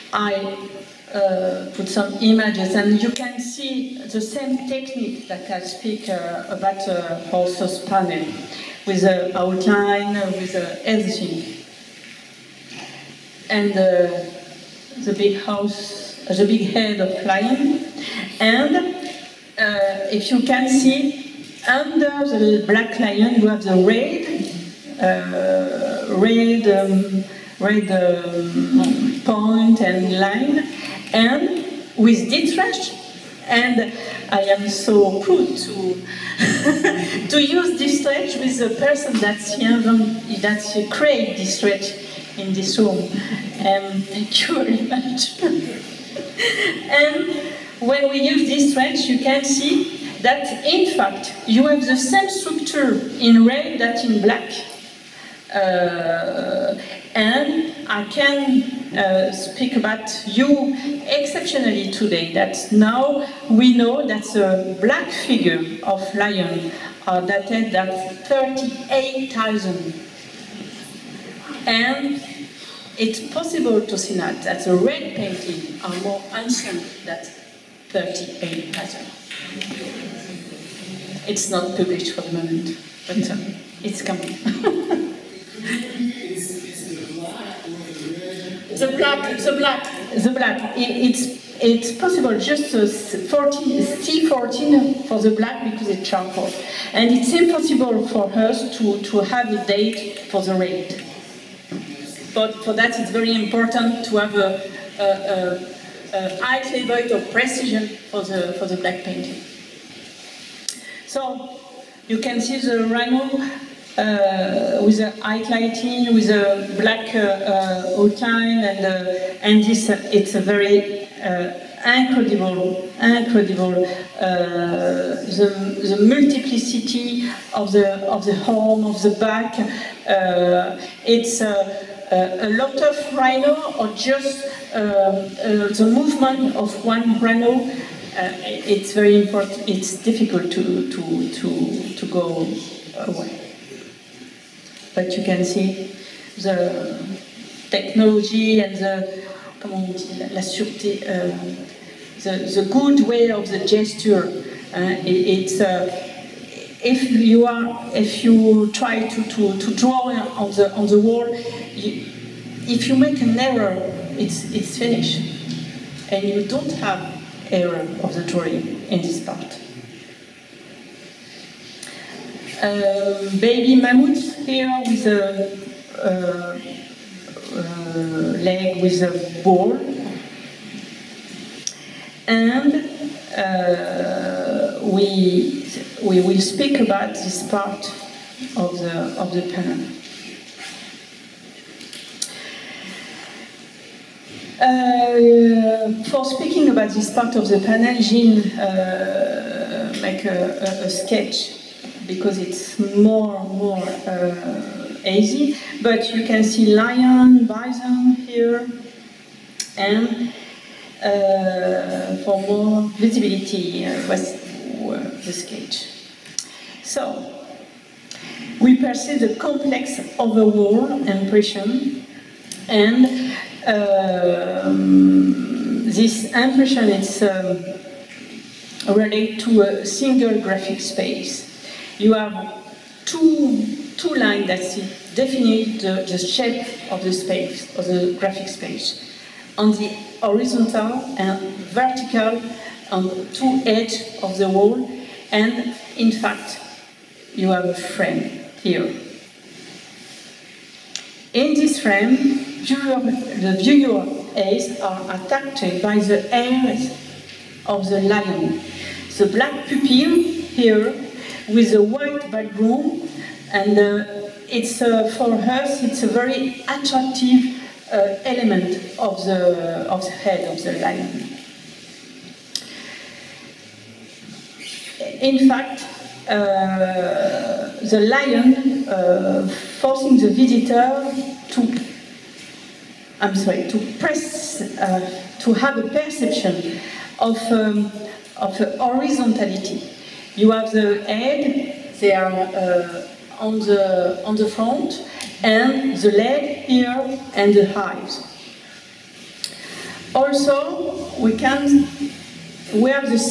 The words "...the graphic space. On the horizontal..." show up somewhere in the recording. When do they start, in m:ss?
3:57.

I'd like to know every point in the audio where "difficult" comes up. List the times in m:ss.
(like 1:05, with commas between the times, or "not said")
2:19.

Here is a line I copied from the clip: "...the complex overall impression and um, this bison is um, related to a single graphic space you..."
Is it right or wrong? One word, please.
wrong.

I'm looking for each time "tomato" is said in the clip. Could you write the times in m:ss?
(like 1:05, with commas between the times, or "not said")
not said.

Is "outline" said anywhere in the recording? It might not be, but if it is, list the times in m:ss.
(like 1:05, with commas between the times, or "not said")
0:09, 1:58.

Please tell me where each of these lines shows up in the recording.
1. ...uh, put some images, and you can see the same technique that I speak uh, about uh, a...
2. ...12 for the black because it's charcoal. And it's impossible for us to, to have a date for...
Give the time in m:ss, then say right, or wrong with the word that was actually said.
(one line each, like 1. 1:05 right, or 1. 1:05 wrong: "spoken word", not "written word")
1. 0:01 right
2. 1:34 wrong: "14", not "12".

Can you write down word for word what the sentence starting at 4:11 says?
In this frame, viewer, the viewer eyes are attracted by the eyes of the lion.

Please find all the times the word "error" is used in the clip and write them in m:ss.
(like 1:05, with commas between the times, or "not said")
2:43, 2:47.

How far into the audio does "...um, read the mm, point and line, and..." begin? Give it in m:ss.
0:26.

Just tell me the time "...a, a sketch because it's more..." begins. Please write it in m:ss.
3:20.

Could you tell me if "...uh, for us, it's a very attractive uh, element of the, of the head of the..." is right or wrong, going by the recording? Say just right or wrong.
right.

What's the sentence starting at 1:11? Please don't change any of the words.
And it's possible to see now that the red painting are more ancient than 38,000.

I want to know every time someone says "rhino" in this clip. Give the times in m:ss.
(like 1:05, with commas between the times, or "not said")
1:52, 2:13, 2:17.